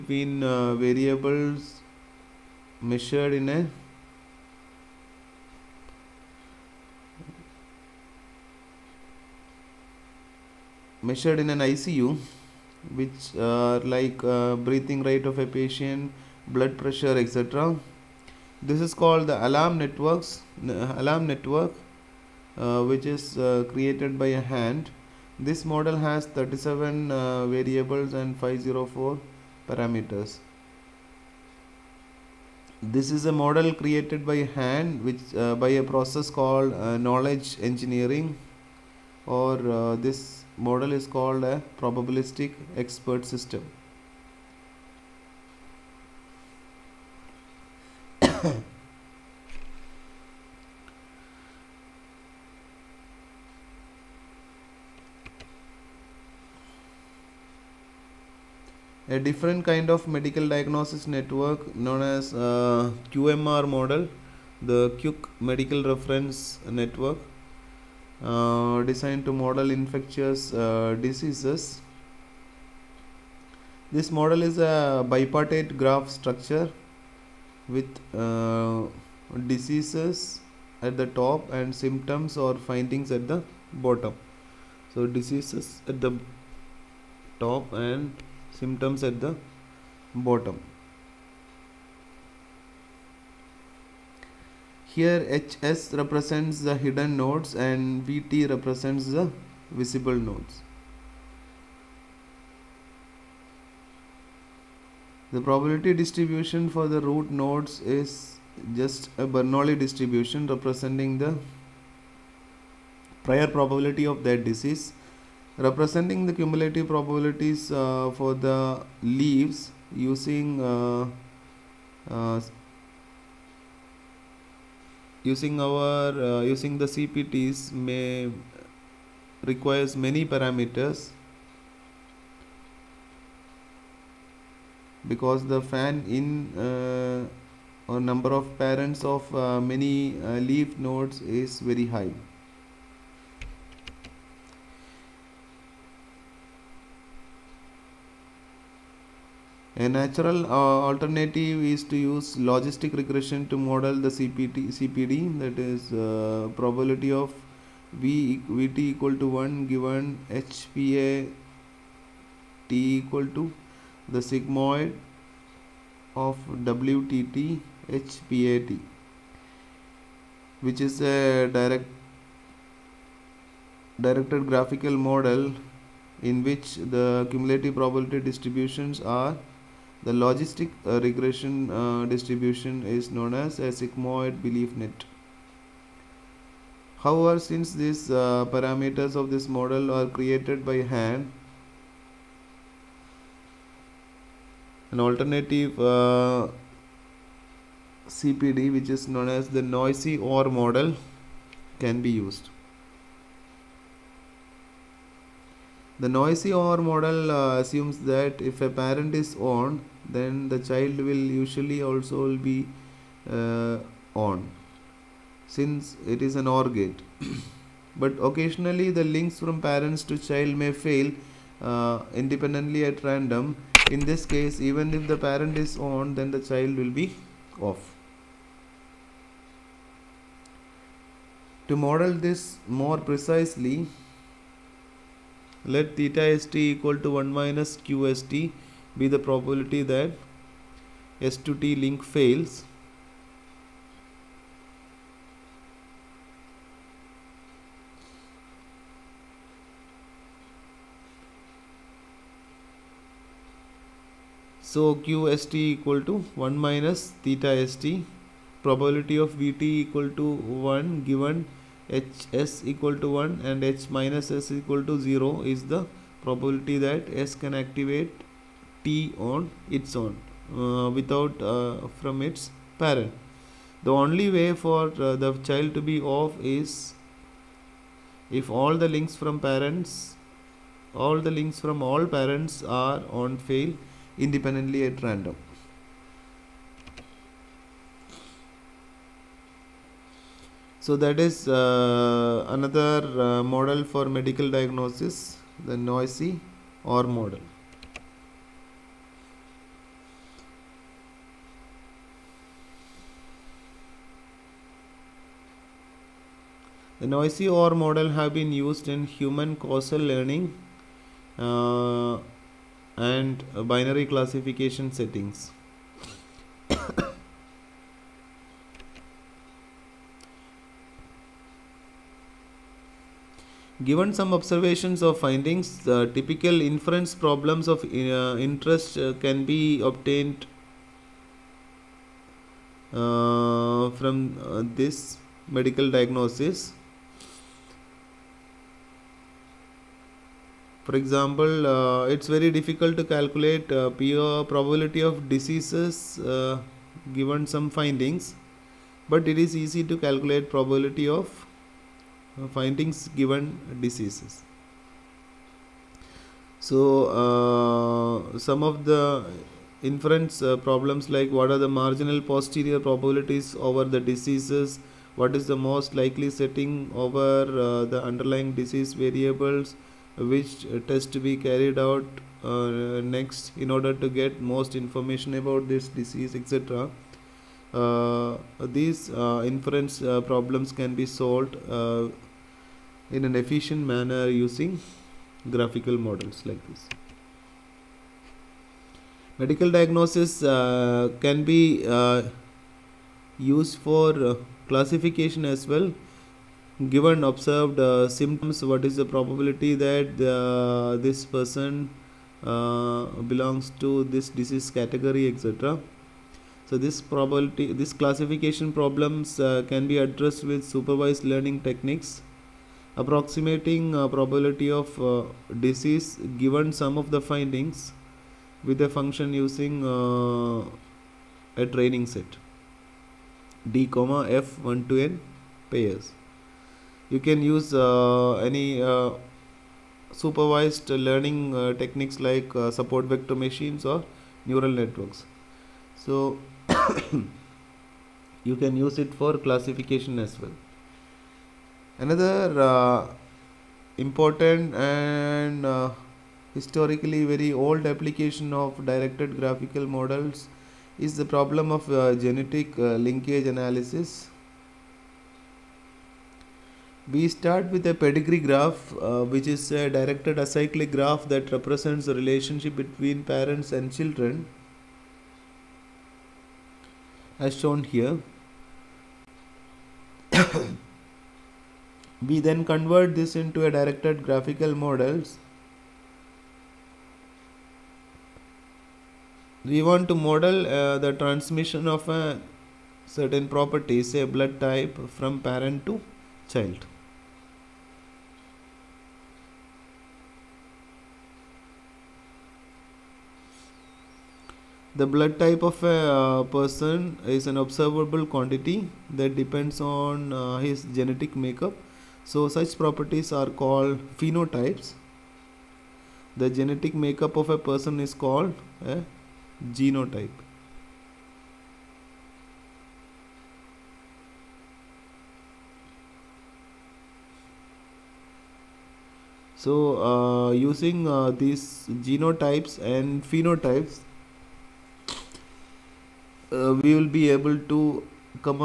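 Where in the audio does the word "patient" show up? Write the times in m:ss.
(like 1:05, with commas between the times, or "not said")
0:15.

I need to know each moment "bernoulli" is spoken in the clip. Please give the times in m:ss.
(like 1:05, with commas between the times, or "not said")
1:49.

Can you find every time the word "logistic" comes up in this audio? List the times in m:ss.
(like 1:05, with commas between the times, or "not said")
2:32, 3:00.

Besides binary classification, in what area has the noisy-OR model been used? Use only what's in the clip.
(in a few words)
Human causal learning.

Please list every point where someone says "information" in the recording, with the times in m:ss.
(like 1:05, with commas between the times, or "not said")
6:14.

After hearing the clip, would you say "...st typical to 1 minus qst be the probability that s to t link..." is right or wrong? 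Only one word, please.
wrong.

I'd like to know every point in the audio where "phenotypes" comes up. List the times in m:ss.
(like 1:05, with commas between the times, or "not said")
8:24, 8:43.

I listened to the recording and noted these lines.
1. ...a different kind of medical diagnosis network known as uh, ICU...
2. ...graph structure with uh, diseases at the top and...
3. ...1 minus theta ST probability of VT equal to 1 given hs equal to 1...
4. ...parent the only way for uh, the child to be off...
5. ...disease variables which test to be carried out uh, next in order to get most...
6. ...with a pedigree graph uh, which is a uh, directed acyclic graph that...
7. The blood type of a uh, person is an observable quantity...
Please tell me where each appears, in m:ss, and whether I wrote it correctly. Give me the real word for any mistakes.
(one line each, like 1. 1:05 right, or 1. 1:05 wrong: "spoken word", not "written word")
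1. 0:59 wrong: "QMR", not "ICU"
2. 1:15 right
3. 4:16 right
4. 4:32 right
5. 6:08 right
6. 7:37 right
7. 8:14 right.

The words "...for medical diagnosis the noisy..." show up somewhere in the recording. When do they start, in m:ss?
4:53.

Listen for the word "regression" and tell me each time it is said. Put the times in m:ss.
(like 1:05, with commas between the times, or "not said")
2:32, 3:00.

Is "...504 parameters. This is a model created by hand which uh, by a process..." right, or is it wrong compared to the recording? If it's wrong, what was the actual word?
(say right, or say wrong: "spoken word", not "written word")
right.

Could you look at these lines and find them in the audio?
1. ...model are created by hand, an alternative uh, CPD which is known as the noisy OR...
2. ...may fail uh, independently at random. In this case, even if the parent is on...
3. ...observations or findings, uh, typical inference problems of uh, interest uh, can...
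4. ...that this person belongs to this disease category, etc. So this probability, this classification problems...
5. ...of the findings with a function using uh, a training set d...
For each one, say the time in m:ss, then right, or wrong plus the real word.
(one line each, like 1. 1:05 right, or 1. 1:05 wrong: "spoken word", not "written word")
1. 3:09 right
2. 3:40 right
3. 5:24 right
4. 6:39 right
5. 6:56 right.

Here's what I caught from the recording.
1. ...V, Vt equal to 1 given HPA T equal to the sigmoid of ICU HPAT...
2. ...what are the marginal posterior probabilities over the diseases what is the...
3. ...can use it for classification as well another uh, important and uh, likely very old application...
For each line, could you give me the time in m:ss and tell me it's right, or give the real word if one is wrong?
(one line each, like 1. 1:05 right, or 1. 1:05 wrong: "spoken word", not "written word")
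1. 2:37 wrong: "WTT", not "ICU"
2. 6:01 right
3. 7:18 wrong: "historically", not "likely".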